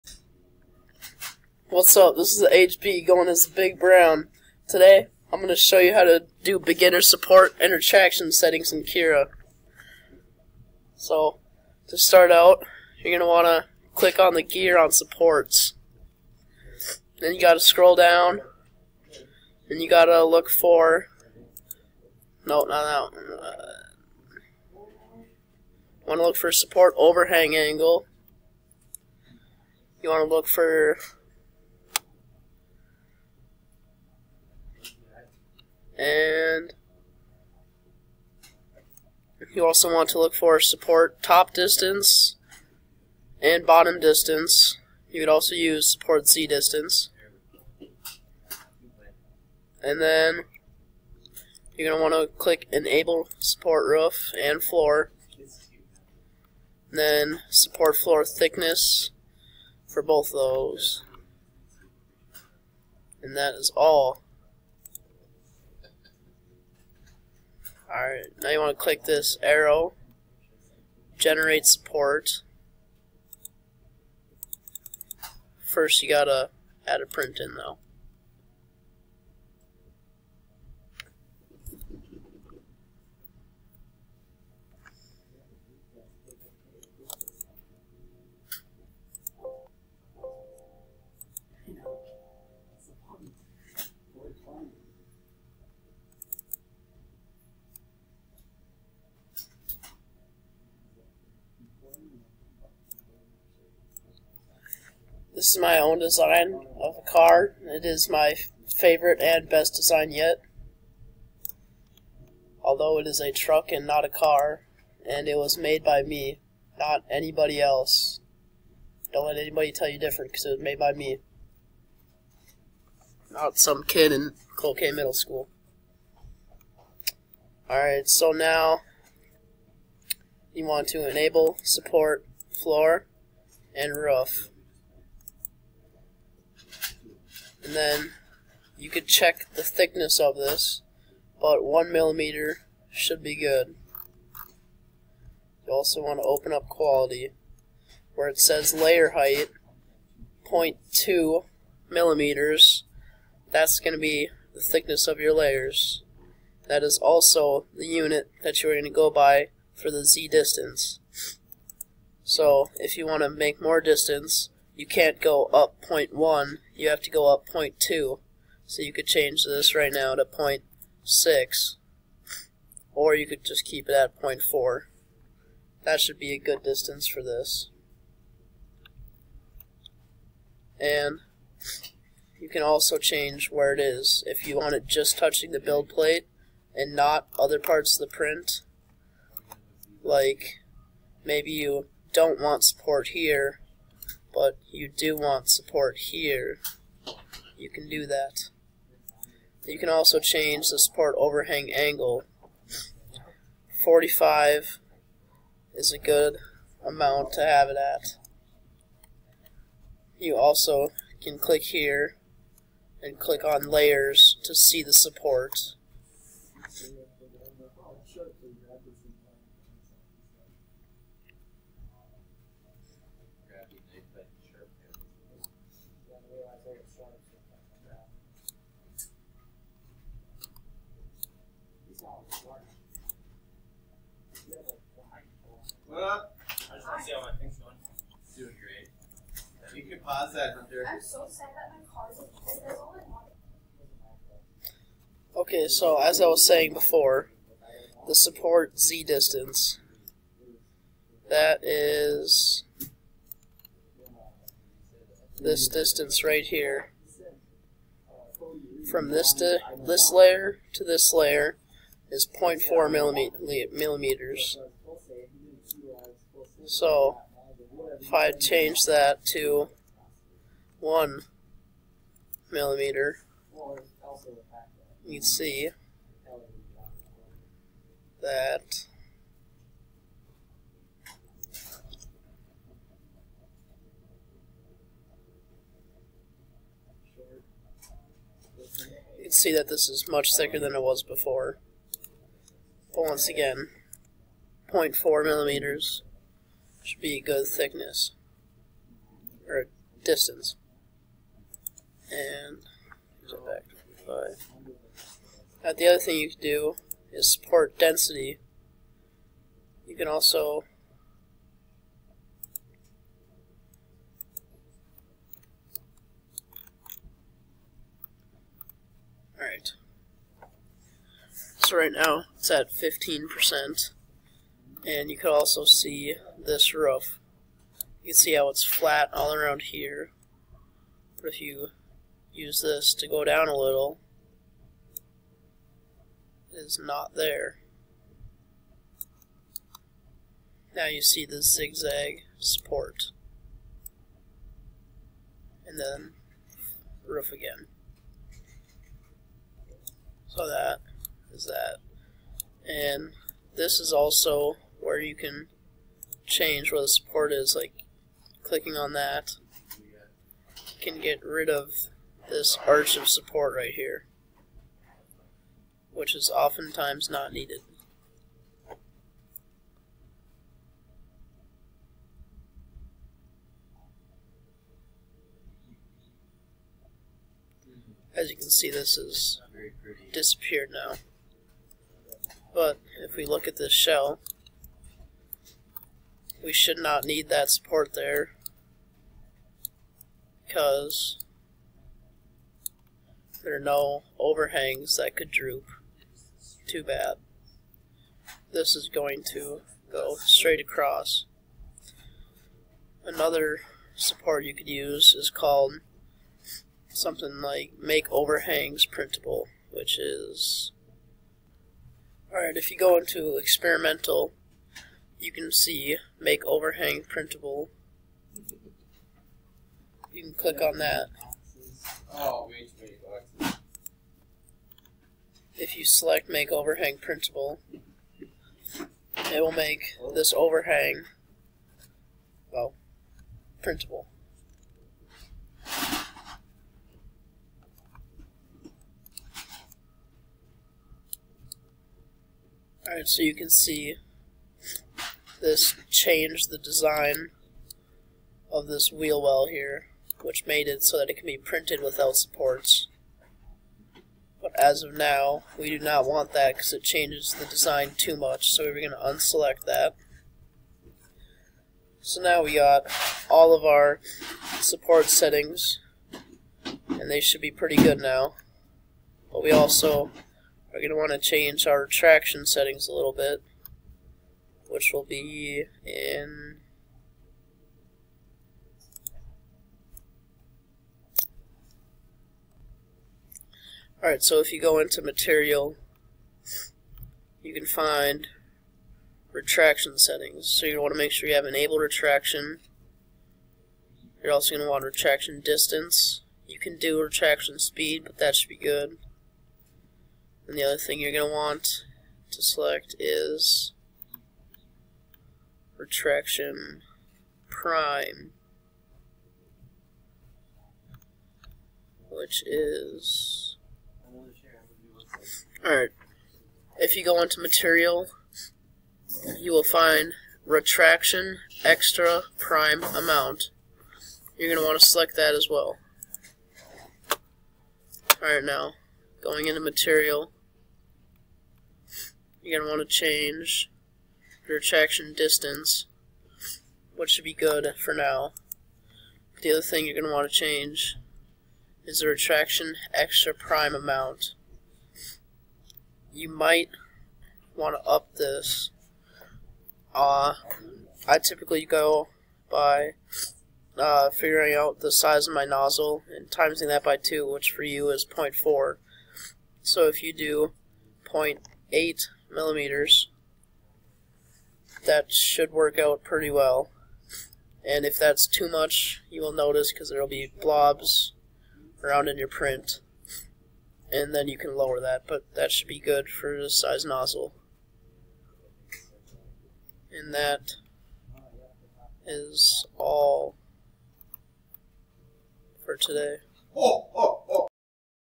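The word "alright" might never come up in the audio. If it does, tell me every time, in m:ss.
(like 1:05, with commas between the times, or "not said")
1:07, 2:07, 5:19, 6:52, 7:22, 8:04, 8:35, 8:48.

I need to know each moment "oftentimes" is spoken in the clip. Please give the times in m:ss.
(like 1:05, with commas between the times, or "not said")
6:06.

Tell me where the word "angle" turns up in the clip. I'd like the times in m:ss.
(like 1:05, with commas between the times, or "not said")
0:27, 3:21.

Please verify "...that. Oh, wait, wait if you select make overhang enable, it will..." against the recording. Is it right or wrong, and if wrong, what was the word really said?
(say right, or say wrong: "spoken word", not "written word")
wrong: "printable", not "enable".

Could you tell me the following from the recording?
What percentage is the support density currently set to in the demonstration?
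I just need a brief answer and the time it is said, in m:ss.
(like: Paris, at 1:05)
15%, at 5:22.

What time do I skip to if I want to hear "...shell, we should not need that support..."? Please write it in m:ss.
6:23.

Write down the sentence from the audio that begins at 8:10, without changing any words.
So you want to make sure you have enabled retraction.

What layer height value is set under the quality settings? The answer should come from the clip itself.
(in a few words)
0.2 millimeters.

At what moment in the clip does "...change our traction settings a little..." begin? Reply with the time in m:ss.
7:51.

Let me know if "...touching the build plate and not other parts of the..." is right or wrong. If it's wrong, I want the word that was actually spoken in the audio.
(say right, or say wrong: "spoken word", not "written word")
right.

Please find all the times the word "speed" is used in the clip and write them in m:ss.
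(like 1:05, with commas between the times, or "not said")
8:17.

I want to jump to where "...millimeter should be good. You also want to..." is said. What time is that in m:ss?
2:21.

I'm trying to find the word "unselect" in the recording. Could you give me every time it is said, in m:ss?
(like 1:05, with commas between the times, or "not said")
7:38.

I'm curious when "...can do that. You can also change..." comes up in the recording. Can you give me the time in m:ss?
3:17.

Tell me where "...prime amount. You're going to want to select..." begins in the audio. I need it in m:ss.
8:42.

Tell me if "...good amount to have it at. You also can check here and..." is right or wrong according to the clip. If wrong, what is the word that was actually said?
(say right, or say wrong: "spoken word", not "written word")
wrong: "click", not "check".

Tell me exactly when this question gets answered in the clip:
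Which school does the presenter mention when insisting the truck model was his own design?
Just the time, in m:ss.
2:04.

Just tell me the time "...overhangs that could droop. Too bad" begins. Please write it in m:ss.
6:34.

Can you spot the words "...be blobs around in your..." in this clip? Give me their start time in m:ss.
9:30.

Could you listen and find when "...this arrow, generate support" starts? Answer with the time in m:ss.
1:09.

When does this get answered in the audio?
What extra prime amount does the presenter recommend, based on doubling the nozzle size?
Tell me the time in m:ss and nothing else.
9:21.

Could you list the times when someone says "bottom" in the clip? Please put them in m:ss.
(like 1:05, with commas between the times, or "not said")
0:43.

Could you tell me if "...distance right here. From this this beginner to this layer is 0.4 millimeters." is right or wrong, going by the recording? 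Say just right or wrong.
wrong.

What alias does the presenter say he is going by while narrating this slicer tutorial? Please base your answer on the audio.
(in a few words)
Big Brown.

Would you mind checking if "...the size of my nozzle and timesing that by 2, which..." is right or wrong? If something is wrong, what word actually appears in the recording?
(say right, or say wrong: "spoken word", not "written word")
right.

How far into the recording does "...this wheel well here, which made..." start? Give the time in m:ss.
7:28.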